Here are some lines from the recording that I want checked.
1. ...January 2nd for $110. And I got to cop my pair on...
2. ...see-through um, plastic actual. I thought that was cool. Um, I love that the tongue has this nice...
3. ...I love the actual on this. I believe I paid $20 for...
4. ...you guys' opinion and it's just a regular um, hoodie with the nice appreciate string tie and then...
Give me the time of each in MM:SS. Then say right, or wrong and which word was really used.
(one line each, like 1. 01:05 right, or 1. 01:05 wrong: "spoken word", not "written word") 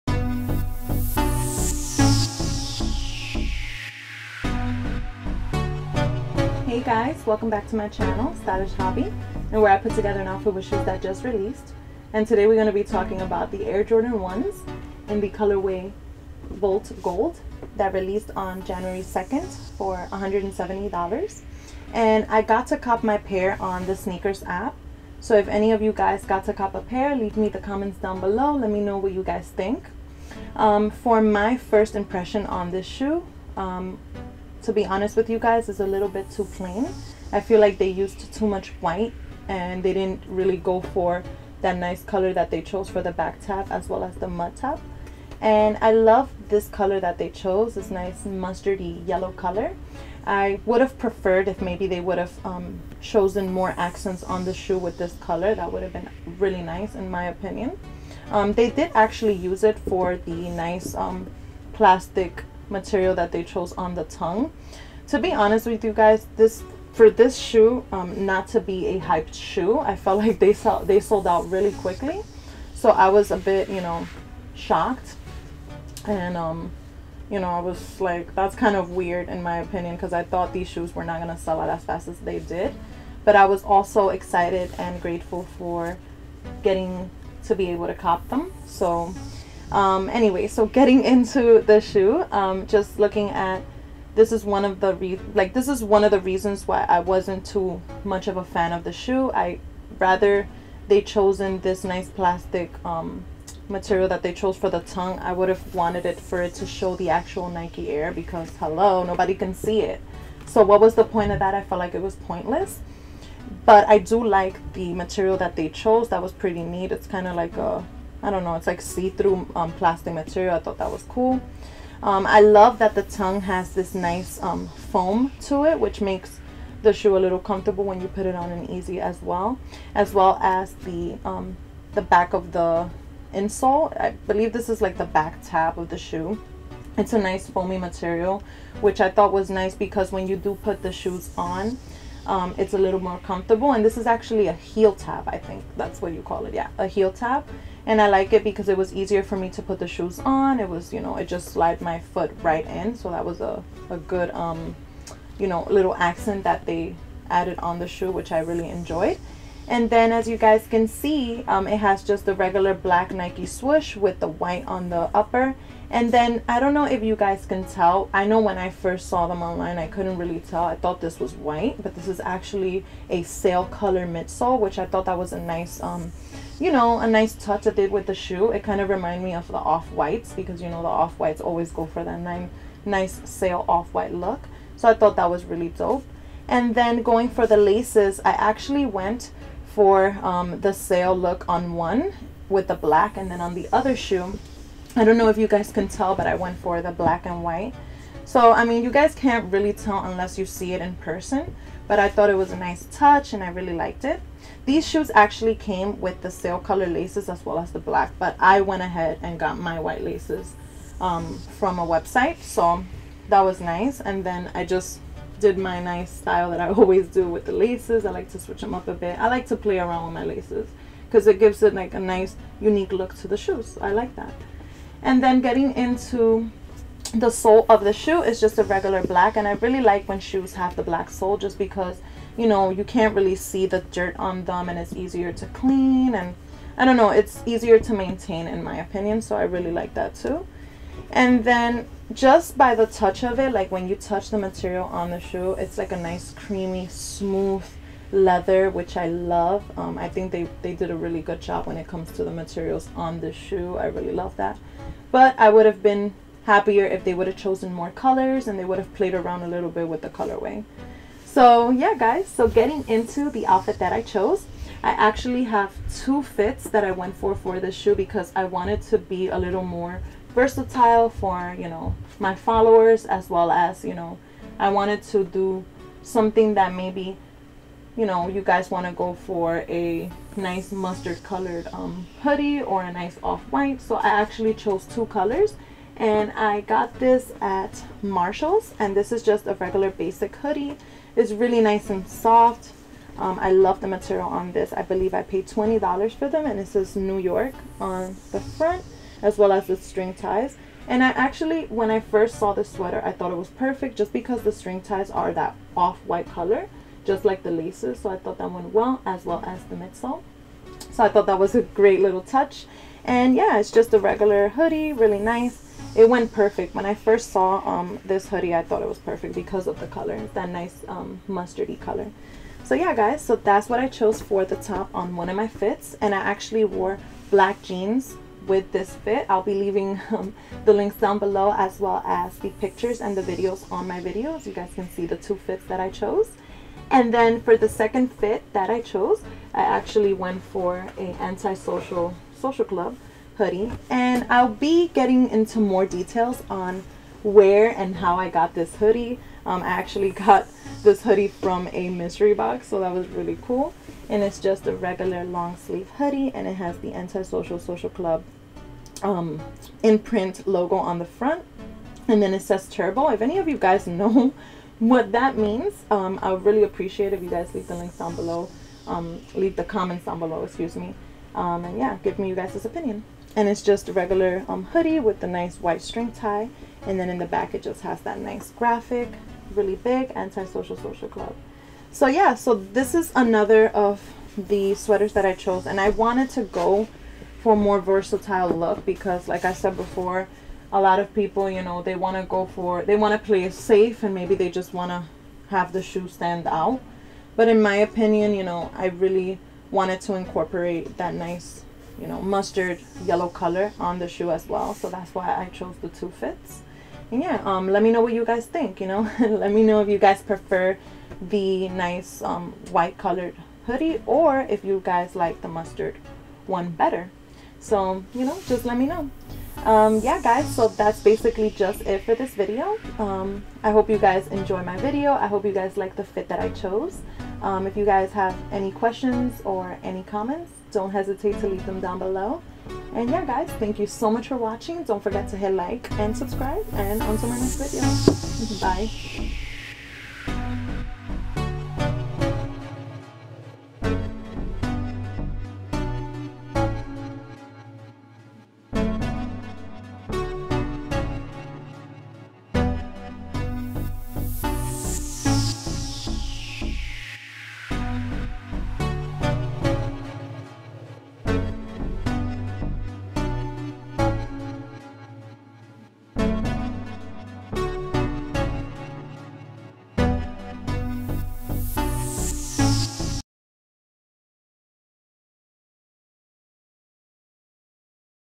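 1. 00:18 wrong: "170", not "110"
2. 01:58 wrong: "material", not "actual"
3. 04:53 wrong: "material", not "actual"
4. 06:12 wrong: "white", not "appreciate".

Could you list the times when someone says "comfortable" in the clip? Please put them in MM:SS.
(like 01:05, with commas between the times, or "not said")
02:07, 02:23.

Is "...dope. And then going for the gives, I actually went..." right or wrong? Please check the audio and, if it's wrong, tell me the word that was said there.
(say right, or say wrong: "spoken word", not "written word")
wrong: "laces", not "gives".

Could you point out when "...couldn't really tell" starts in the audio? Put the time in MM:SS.
02:49.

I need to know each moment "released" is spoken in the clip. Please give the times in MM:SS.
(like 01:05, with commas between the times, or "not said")
00:11, 00:17.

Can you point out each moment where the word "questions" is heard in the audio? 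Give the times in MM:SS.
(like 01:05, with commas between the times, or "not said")
07:08.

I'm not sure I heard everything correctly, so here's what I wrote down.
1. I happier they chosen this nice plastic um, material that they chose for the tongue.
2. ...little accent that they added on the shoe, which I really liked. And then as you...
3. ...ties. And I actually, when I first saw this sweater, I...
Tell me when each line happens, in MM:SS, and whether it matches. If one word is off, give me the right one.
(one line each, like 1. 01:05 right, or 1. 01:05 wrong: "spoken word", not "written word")
1. 01:39 wrong: "rather", not "happier"
2. 02:35 wrong: "enjoyed", not "liked"
3. 05:00 right.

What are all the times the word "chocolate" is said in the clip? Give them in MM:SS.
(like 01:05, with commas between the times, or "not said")
not said.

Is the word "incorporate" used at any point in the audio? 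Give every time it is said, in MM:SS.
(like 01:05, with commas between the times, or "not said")
06:40.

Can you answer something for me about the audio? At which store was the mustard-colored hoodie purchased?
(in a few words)
Marshalls.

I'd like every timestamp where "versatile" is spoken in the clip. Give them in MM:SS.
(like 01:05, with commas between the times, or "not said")
04:30, 06:27.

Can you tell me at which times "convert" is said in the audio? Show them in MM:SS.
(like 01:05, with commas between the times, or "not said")
not said.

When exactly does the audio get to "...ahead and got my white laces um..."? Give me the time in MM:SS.
03:28.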